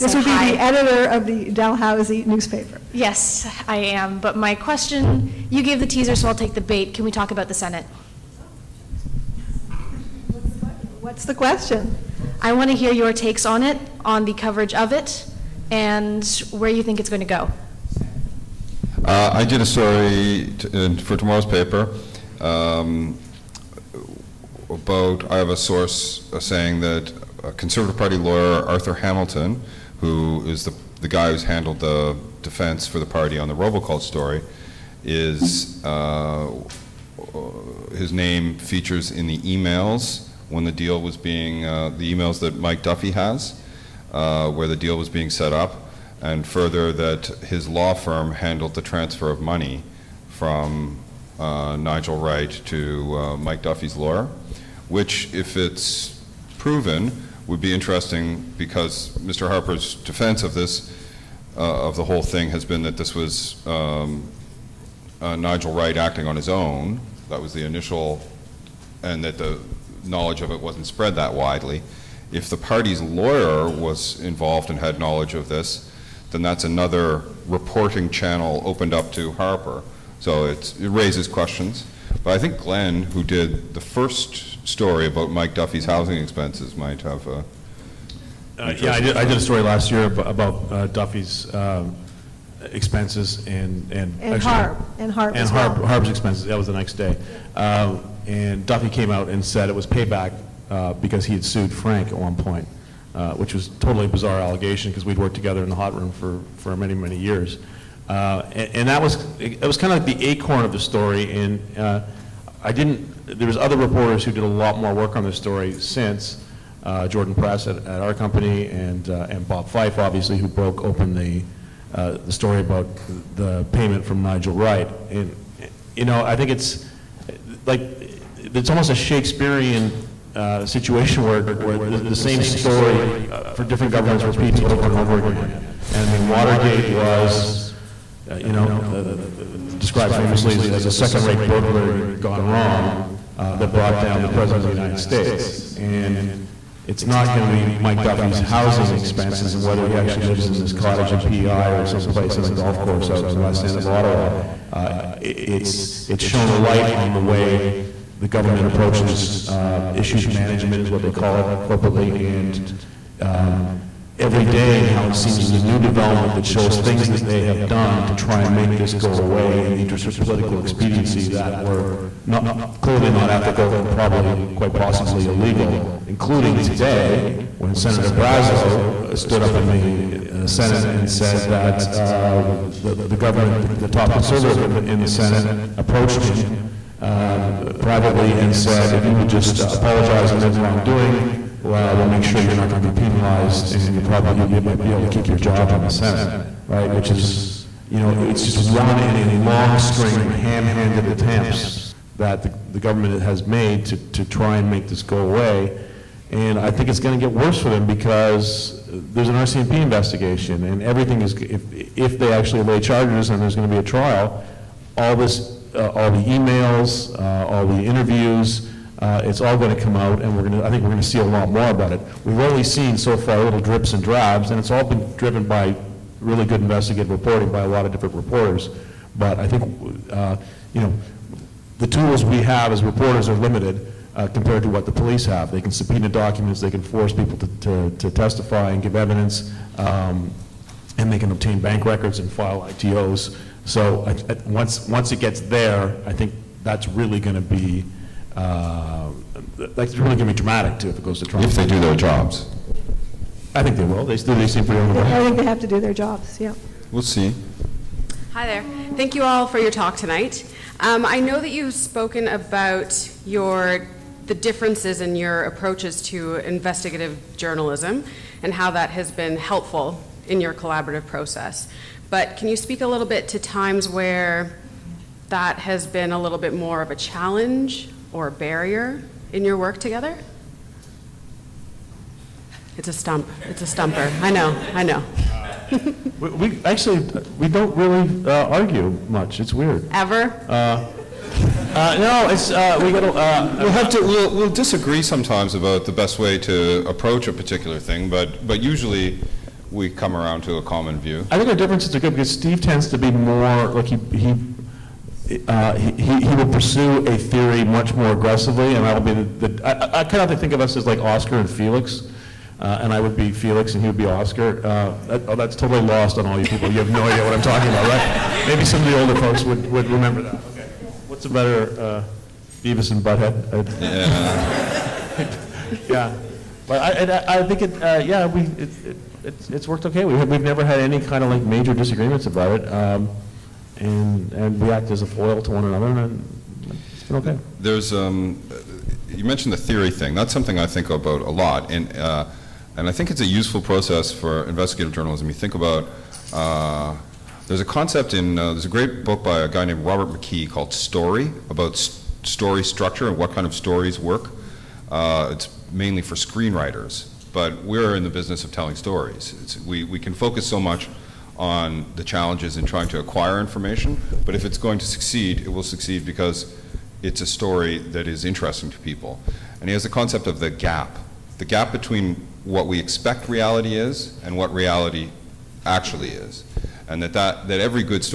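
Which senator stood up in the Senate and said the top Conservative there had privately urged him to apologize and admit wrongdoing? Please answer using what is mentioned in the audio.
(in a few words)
Brazeau.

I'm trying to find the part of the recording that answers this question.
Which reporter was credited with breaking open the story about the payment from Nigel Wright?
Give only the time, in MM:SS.
01:59.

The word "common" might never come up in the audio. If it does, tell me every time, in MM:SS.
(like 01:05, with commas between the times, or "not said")
05:00.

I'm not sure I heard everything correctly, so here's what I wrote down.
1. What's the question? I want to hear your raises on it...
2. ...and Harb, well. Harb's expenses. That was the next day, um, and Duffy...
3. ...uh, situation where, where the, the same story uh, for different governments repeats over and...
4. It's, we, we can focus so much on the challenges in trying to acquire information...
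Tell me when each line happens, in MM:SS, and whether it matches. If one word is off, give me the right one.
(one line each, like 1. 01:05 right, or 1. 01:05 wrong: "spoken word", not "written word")
1. 00:11 wrong: "takes", not "raises"
2. 01:35 right
3. 02:10 right
4. 05:59 right.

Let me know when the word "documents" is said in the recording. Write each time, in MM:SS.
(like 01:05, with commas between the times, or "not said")
03:56.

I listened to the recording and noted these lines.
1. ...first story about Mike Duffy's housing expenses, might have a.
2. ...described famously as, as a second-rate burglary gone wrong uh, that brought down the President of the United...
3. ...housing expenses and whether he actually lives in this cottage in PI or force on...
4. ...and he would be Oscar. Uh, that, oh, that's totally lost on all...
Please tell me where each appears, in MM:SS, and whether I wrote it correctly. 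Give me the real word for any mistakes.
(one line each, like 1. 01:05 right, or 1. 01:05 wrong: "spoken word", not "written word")
1. 01:23 right
2. 02:19 right
3. 02:28 wrong: "someplace", not "force"
4. 05:13 right.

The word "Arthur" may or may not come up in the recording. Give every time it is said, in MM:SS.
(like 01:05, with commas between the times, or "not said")
00:28.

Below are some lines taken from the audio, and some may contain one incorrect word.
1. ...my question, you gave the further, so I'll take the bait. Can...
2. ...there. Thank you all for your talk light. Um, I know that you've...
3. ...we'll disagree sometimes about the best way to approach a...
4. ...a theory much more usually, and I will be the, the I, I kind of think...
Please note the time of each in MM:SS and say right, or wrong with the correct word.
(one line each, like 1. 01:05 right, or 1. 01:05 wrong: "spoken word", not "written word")
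1. 00:04 wrong: "teaser", not "further"
2. 04:18 wrong: "tonight", not "light"
3. 04:54 right
4. 05:07 wrong: "aggressively", not "usually".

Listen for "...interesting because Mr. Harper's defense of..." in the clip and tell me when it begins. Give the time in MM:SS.
00:57.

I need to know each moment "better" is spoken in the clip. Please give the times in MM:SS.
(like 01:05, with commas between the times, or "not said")
05:21.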